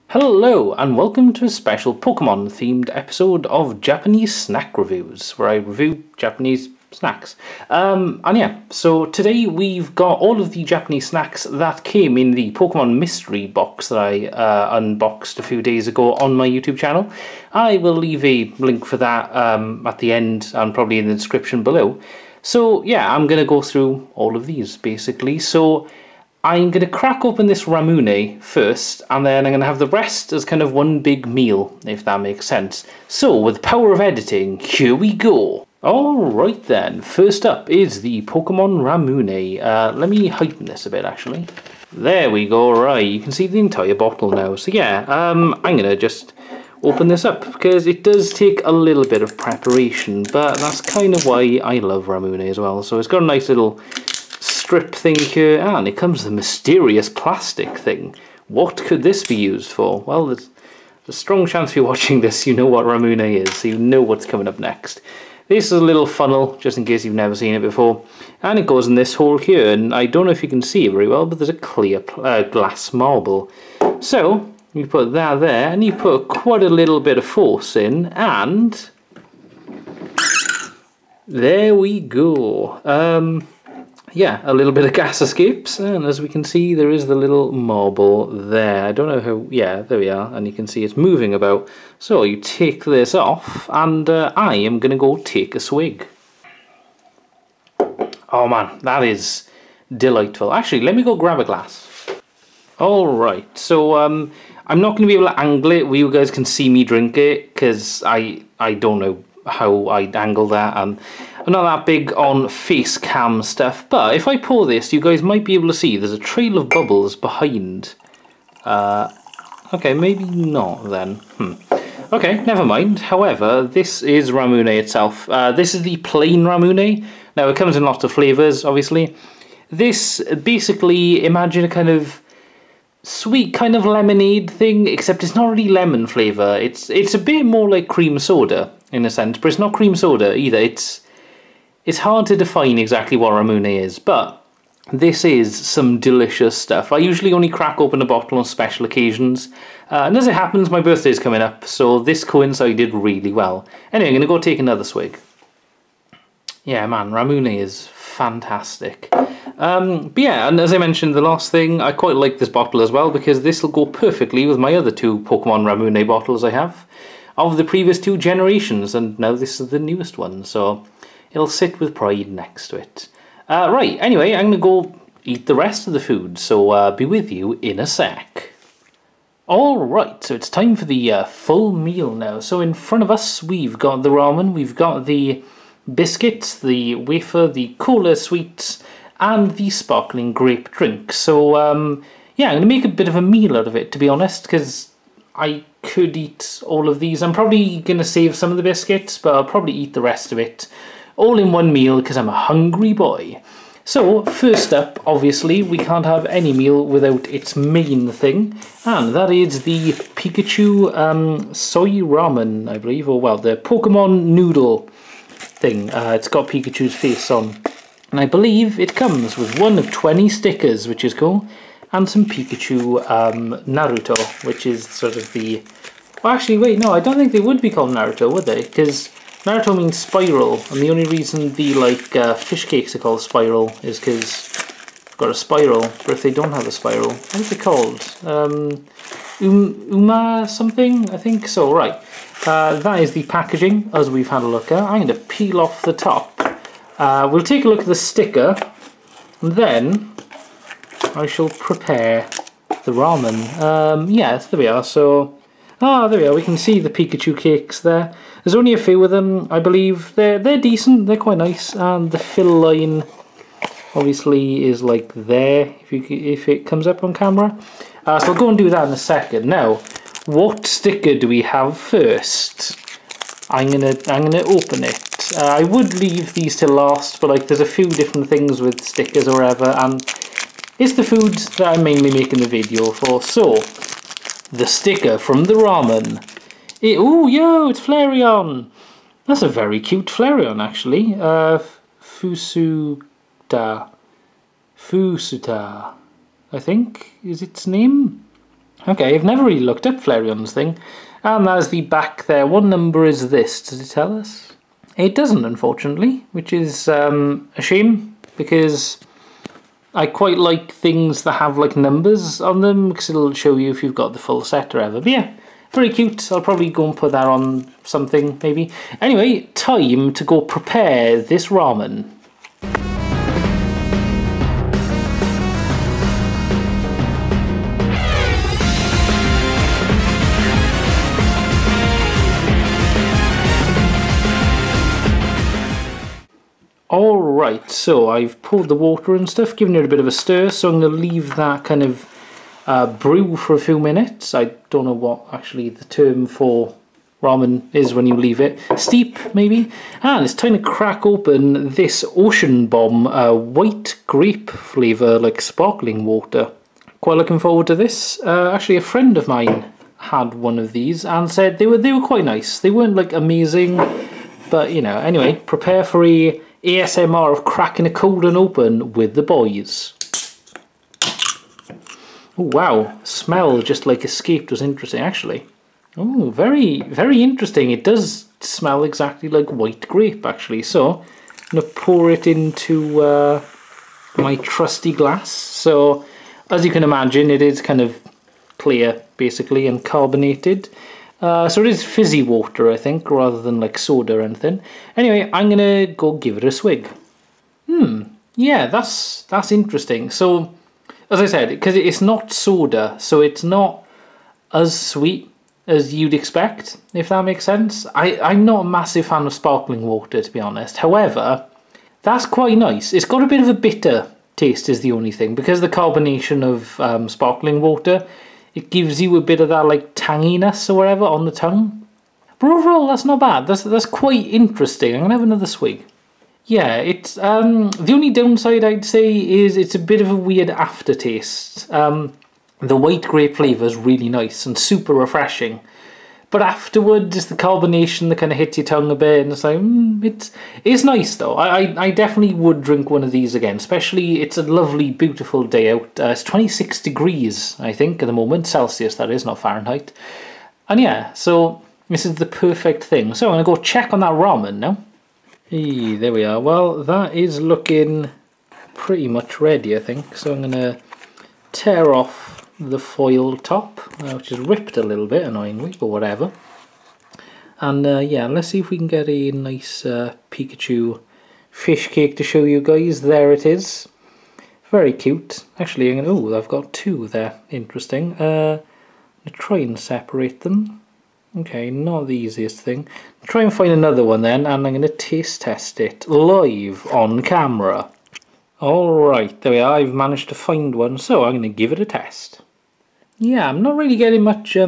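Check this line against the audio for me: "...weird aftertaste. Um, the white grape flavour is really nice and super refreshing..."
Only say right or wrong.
right.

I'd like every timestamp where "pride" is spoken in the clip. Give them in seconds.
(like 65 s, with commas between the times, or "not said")
171 s.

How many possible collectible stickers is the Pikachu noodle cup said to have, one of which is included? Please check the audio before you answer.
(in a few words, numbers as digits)
20.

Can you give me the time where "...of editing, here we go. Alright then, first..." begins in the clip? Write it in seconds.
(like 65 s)
33 s.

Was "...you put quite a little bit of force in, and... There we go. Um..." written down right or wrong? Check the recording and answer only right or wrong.
right.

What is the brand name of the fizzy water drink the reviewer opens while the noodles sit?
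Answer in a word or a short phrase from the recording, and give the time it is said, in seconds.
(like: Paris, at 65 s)
Ocean Bomb, at 352 s.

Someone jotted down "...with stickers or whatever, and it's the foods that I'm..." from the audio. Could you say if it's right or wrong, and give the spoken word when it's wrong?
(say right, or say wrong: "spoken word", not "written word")
right.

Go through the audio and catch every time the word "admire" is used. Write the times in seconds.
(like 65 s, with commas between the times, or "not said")
not said.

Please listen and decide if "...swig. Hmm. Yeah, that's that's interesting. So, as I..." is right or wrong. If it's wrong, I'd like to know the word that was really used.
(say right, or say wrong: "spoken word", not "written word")
right.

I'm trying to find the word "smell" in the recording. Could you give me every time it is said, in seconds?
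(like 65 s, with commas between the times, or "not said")
373 s, 378 s.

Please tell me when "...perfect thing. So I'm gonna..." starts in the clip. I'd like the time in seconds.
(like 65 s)
452 s.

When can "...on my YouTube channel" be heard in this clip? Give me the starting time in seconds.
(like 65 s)
16 s.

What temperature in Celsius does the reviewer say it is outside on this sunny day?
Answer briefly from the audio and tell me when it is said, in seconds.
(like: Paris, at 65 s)
26, at 446 s.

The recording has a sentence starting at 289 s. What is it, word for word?
That's a very cute Flareon, actually.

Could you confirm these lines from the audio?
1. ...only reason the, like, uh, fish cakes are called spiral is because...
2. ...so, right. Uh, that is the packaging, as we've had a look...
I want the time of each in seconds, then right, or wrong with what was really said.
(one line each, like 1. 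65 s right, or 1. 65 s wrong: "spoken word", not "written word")
1. 230 s right
2. 241 s right.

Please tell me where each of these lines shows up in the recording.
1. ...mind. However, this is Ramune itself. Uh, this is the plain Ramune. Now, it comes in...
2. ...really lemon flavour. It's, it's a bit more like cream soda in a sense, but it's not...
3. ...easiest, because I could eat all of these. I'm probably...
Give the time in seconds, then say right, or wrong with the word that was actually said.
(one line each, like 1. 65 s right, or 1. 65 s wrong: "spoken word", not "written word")
1. 122 s right
2. 135 s right
3. 194 s wrong: "honest", not "easiest".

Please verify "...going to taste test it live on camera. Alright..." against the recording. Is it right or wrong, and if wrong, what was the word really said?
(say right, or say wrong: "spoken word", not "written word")
right.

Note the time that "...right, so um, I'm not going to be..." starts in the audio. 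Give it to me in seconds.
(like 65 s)
103 s.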